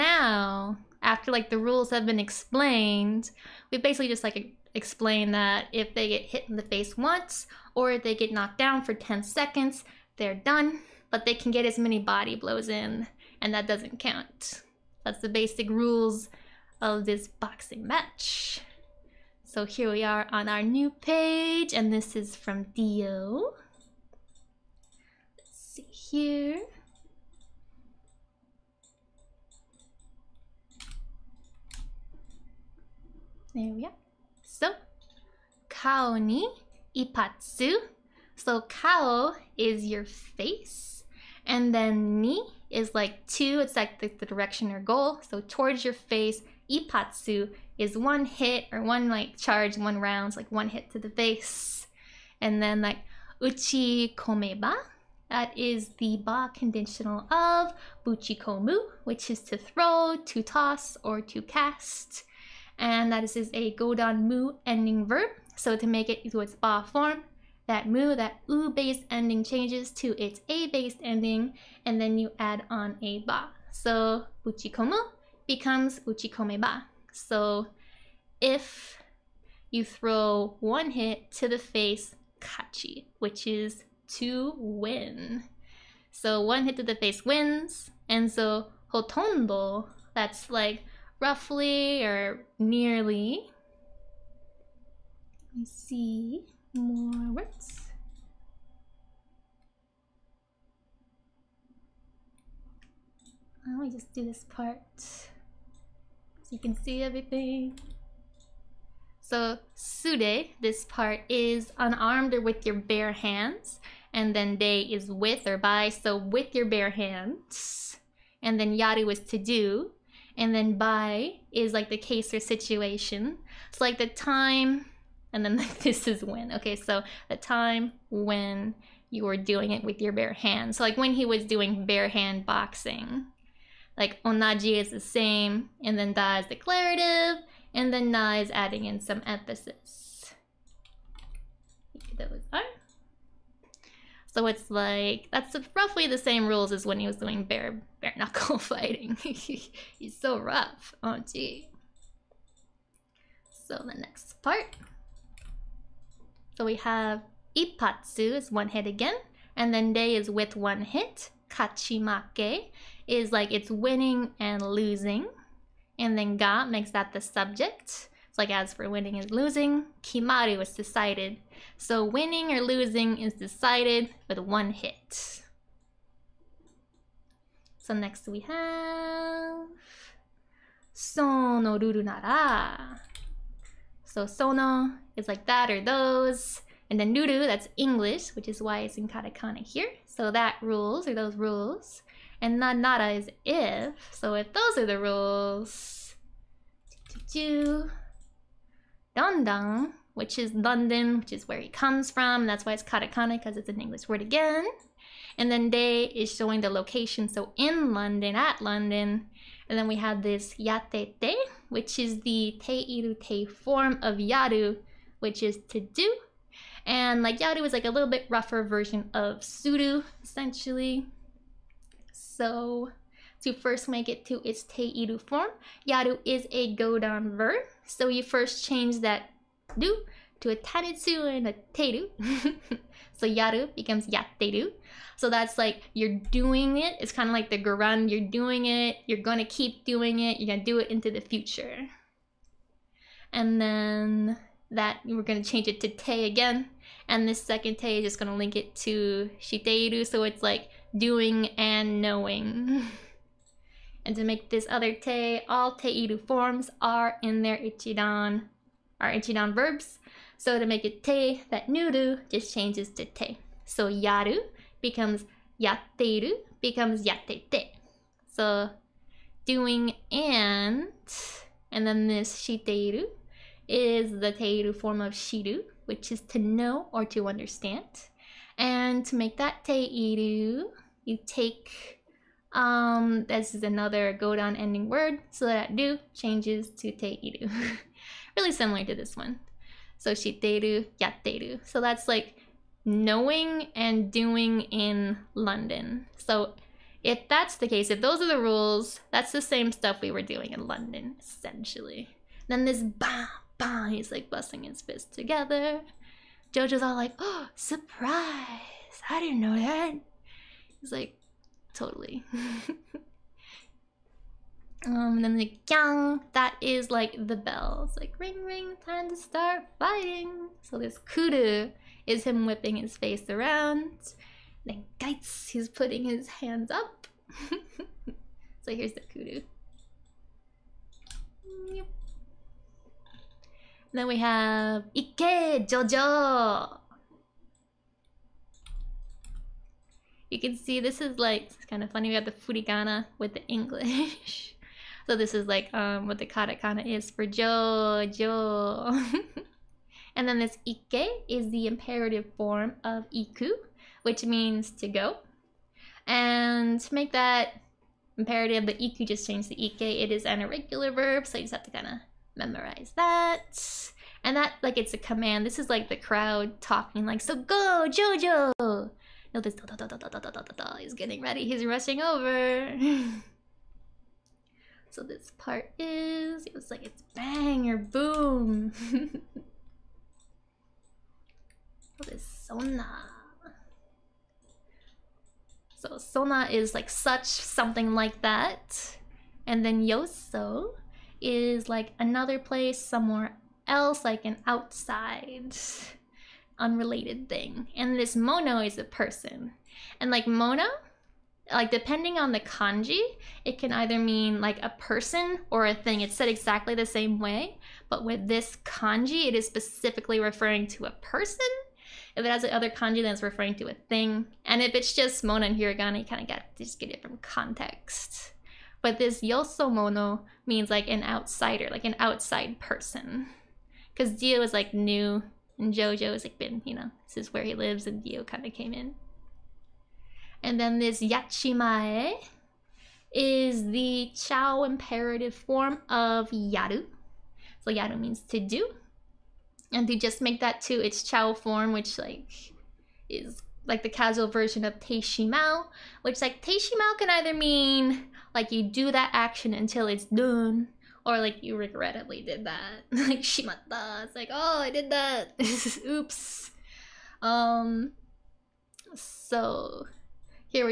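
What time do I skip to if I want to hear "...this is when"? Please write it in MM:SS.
02:05.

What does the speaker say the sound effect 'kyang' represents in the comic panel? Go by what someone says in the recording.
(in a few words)
the bells.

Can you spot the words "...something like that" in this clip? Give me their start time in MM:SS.
06:27.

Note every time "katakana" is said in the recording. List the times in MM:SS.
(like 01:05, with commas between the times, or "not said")
03:09, 03:22, 05:46.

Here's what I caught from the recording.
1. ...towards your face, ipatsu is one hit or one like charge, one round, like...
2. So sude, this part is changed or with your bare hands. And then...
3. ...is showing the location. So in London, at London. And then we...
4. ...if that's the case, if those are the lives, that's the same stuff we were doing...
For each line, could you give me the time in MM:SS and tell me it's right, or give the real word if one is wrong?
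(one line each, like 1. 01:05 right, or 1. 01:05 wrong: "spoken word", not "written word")
1. 00:45 right
2. 01:49 wrong: "unarmed", not "changed"
3. 03:26 right
4. 04:57 wrong: "rules", not "lives".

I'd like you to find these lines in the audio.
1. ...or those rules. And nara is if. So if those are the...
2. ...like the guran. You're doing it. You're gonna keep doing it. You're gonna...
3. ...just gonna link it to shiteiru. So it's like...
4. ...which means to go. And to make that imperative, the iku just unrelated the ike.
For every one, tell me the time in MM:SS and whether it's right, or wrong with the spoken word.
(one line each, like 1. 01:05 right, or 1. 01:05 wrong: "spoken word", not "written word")
1. 03:11 right
2. 03:57 right
3. 04:08 right
4. 05:54 wrong: "changed", not "unrelated".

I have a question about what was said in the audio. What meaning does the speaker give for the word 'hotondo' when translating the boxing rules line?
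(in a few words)
roughly or nearly.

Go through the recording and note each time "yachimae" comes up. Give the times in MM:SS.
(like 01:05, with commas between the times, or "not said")
07:11.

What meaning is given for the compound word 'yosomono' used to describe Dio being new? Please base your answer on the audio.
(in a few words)
an outsider.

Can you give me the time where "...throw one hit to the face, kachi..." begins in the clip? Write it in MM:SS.
01:19.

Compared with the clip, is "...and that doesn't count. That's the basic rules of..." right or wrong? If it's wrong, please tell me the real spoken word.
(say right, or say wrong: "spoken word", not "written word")
right.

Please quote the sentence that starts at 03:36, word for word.
And like yaru is like a little bit rougher version of suru, essentially.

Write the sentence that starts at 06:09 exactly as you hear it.
No, this da da da da da da da da da is getting ready.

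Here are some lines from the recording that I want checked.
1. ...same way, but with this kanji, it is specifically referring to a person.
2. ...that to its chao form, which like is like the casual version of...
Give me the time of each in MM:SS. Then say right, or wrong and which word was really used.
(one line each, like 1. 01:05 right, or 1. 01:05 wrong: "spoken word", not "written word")
1. 06:46 right
2. 07:20 right.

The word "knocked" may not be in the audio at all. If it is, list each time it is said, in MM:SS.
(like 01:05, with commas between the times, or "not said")
00:08.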